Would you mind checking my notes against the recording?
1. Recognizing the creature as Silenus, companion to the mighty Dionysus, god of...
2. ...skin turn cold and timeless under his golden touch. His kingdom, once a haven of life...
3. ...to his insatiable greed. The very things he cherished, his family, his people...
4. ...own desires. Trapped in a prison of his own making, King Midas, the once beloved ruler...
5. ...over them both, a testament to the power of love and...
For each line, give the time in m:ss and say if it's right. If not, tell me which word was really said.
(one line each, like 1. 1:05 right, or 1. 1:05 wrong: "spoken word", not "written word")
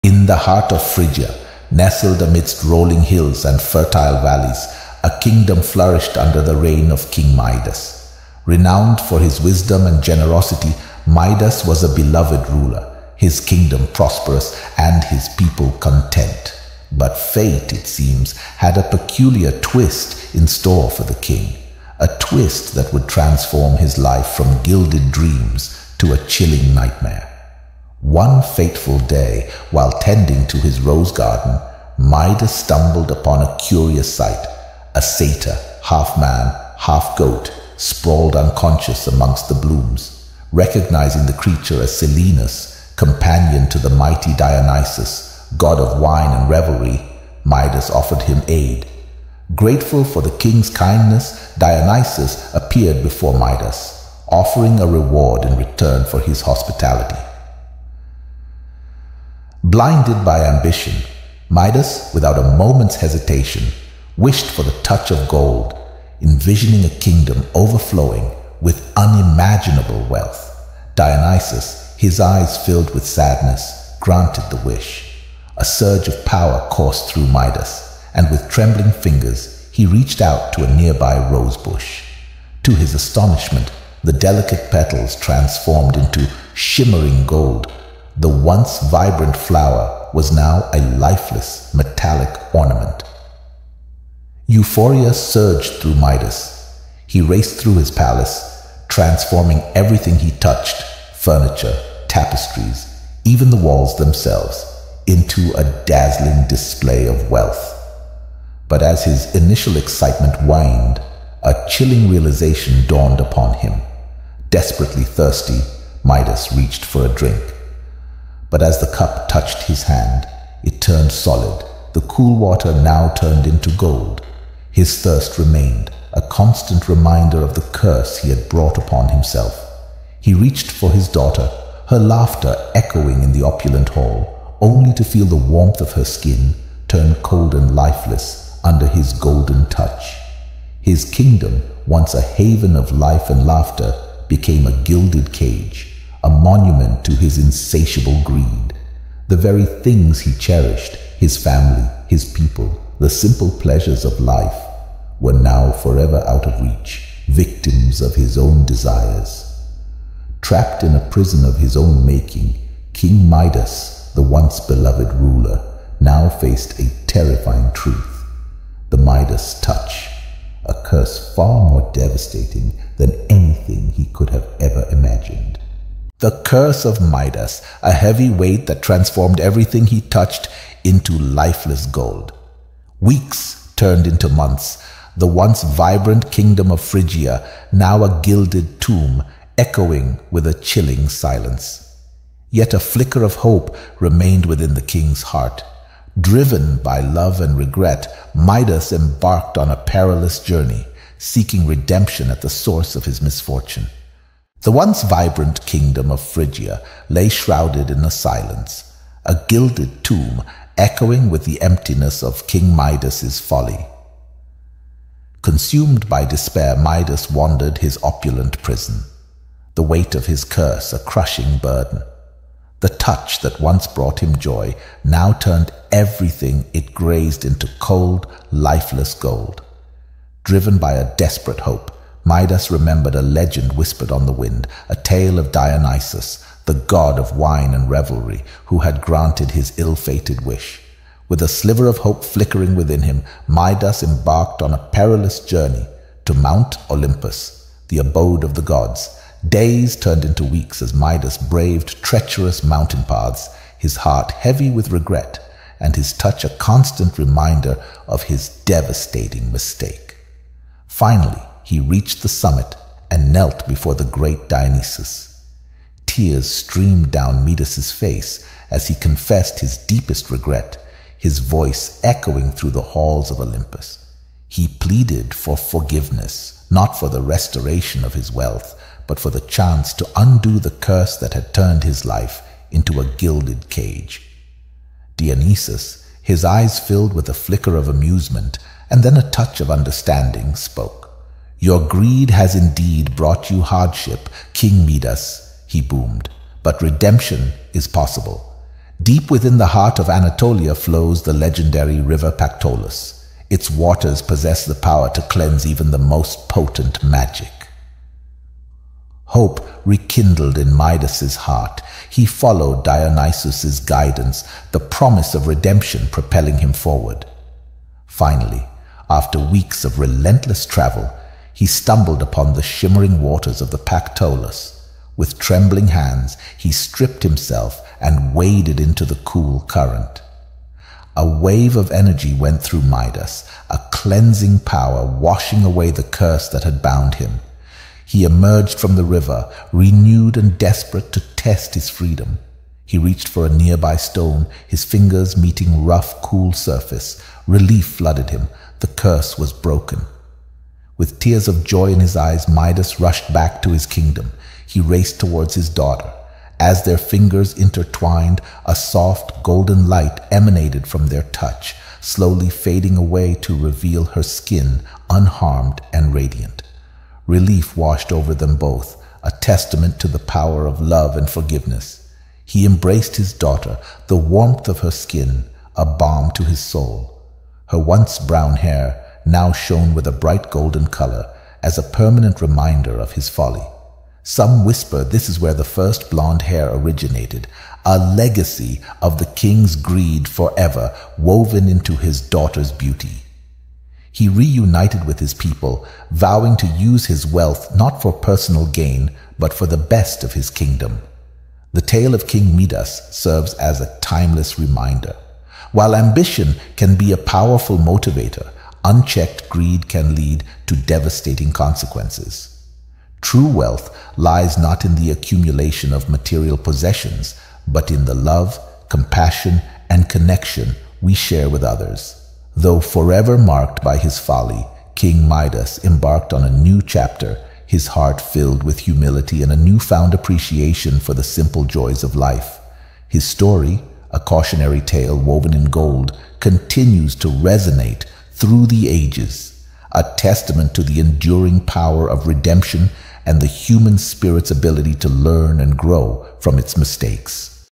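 1. 0:40 right
2. 2:16 wrong: "lifeless", not "timeless"
3. 2:27 right
4. 2:38 right
5. 6:08 right.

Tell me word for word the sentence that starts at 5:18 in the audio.
Finally, after weeks of relentless travel, he stumbled upon the shimmering waters of the Pactolus.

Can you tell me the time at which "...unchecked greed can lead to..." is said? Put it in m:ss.
6:48.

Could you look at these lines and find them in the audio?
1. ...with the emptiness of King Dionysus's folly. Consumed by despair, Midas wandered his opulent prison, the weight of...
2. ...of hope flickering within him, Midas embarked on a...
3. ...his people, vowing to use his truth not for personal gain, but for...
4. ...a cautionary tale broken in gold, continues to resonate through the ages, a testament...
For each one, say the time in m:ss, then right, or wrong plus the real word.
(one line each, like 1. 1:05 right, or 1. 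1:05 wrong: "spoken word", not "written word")
1. 3:31 wrong: "Midas", not "Dionysus"
2. 4:01 right
3. 6:35 wrong: "wealth", not "truth"
4. 7:14 wrong: "woven", not "broken".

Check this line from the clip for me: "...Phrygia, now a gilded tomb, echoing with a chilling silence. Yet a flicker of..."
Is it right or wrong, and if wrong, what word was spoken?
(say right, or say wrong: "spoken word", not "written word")
right.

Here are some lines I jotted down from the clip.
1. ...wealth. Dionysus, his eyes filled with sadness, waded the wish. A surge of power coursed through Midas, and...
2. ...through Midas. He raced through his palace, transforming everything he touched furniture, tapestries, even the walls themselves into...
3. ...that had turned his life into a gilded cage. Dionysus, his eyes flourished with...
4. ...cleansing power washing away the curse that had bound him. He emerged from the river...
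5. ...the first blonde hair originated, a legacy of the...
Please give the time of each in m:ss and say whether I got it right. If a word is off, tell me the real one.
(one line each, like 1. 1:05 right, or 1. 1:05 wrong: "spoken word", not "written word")
1. 1:10 wrong: "granted", not "waded"
2. 1:35 right
3. 4:41 wrong: "filled", not "flourished"
4. 5:33 right
5. 6:25 right.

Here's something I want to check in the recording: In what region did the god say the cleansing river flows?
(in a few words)
Anatolia.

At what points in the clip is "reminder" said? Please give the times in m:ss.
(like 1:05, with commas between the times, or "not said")
2:06, 4:17, 6:22, 6:44.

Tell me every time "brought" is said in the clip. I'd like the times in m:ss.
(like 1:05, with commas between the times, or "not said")
2:08, 3:43, 4:53.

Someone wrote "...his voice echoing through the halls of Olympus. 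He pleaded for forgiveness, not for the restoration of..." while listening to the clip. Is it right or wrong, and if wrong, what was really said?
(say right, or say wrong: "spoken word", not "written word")
right.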